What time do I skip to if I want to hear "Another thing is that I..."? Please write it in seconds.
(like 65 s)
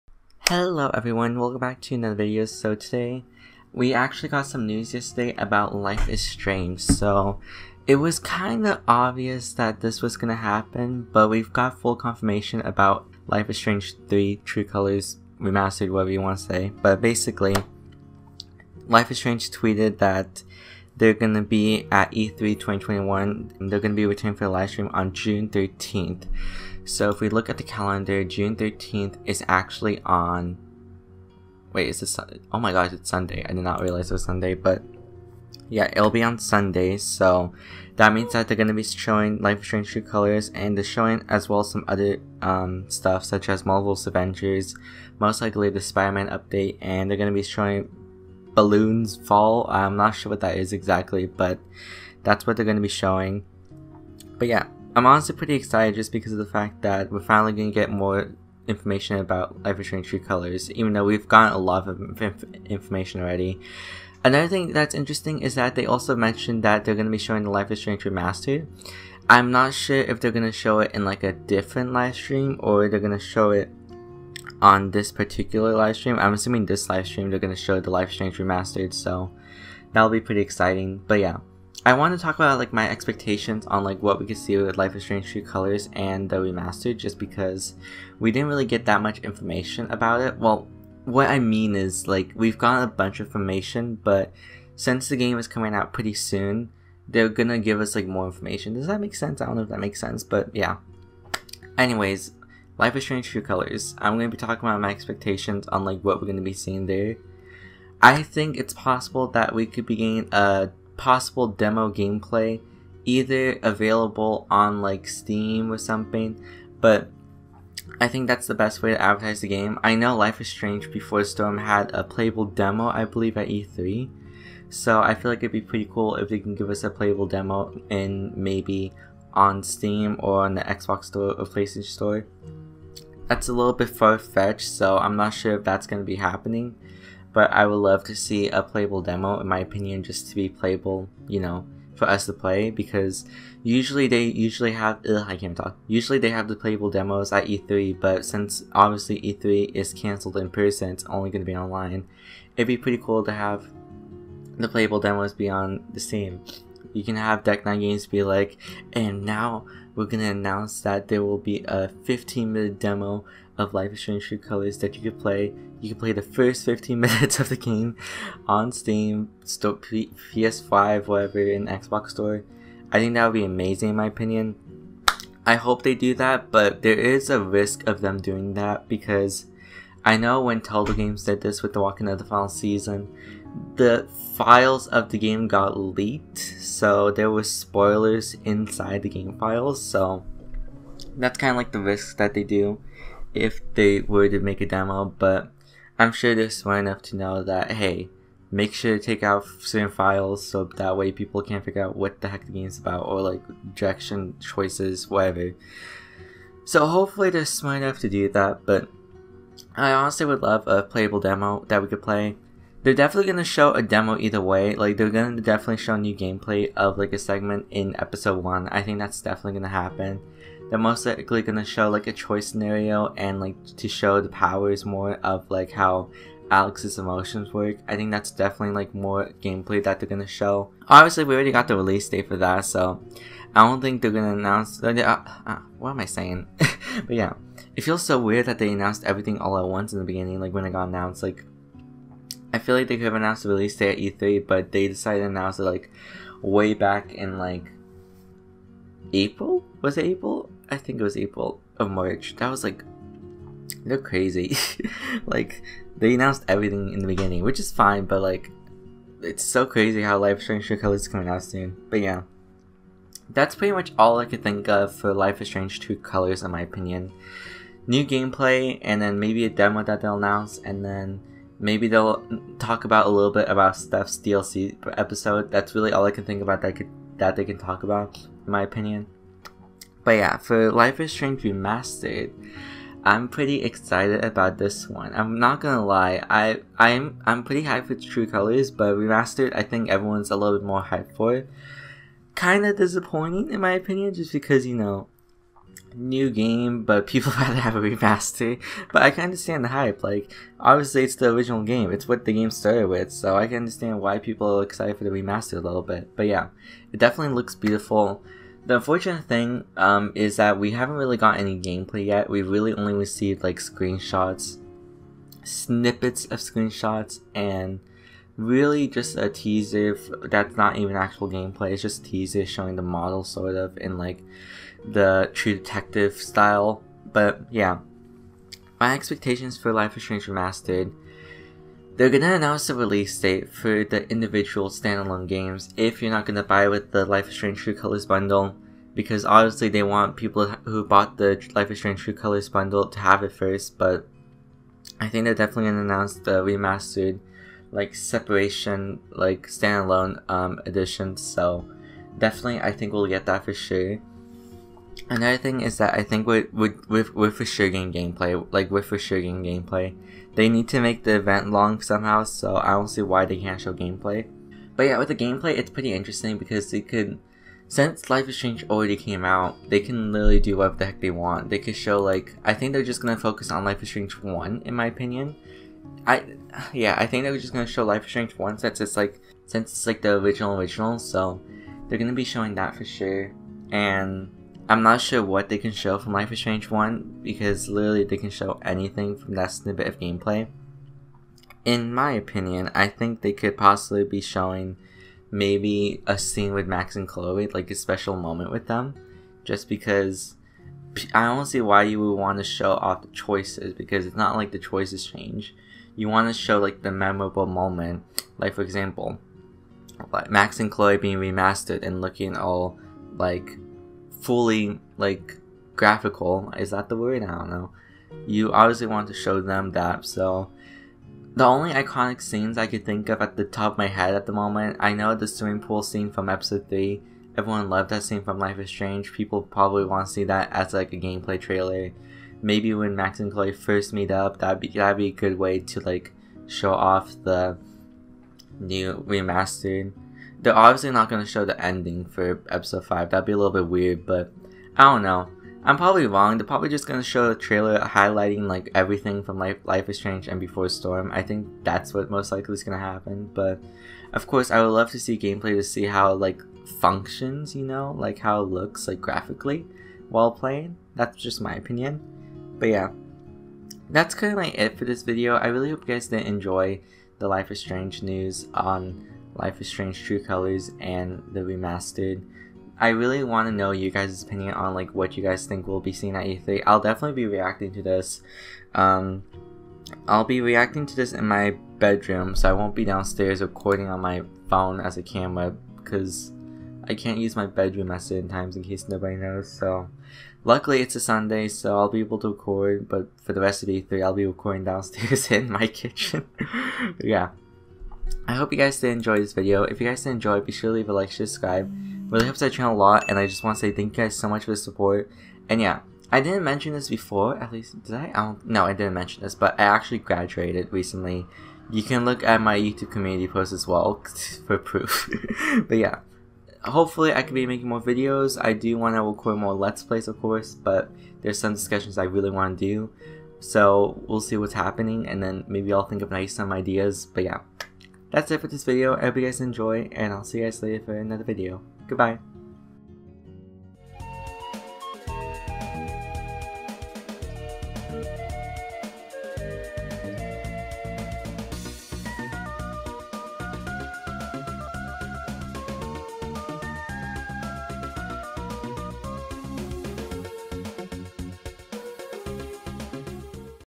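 355 s.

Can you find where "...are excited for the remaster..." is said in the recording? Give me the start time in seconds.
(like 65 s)
304 s.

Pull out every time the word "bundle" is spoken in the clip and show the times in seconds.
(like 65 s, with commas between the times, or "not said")
338 s, 342 s.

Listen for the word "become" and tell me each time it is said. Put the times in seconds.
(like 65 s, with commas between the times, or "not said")
not said.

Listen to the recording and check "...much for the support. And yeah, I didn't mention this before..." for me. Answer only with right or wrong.
right.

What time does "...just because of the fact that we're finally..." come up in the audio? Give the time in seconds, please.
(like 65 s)
55 s.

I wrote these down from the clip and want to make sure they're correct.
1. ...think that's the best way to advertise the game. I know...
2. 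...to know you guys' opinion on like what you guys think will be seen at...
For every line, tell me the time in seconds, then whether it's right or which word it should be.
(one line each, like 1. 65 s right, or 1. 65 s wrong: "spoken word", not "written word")
1. 118 s right
2. 473 s right.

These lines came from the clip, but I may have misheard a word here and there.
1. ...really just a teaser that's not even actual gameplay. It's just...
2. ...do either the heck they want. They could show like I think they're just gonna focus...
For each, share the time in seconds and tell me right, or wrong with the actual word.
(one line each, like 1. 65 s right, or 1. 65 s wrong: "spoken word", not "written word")
1. 318 s right
2. 370 s wrong: "whatever", not "either".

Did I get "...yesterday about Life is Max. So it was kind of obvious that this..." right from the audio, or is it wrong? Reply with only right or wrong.
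wrong.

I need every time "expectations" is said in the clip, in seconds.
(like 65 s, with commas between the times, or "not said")
82 s, 104 s, 328 s.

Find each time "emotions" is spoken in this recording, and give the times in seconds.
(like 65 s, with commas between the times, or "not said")
226 s.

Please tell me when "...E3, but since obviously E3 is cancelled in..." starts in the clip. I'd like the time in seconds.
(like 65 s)
147 s.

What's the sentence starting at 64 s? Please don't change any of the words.
Another thing that's interesting is that they also mentioned that they're going to be showing the Life is Strange Remastered.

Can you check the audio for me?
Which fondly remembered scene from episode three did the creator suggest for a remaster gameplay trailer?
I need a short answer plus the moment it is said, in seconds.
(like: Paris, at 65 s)
swimming pool scene, at 425 s.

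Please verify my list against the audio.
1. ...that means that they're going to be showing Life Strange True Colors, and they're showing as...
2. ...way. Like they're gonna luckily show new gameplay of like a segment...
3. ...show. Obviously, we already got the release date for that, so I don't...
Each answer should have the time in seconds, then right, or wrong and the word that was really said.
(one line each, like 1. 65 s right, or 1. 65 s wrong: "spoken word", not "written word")
1. 37 s right
2. 214 s wrong: "definitely", not "luckily"
3. 230 s right.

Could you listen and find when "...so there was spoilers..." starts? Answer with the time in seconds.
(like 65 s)
186 s.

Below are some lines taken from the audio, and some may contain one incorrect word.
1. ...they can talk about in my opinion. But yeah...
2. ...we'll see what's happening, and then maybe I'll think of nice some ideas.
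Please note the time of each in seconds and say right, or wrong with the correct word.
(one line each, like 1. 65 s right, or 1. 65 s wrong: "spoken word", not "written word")
1. 277 s right
2. 524 s right.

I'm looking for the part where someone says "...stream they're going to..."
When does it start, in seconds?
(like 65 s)
77 s.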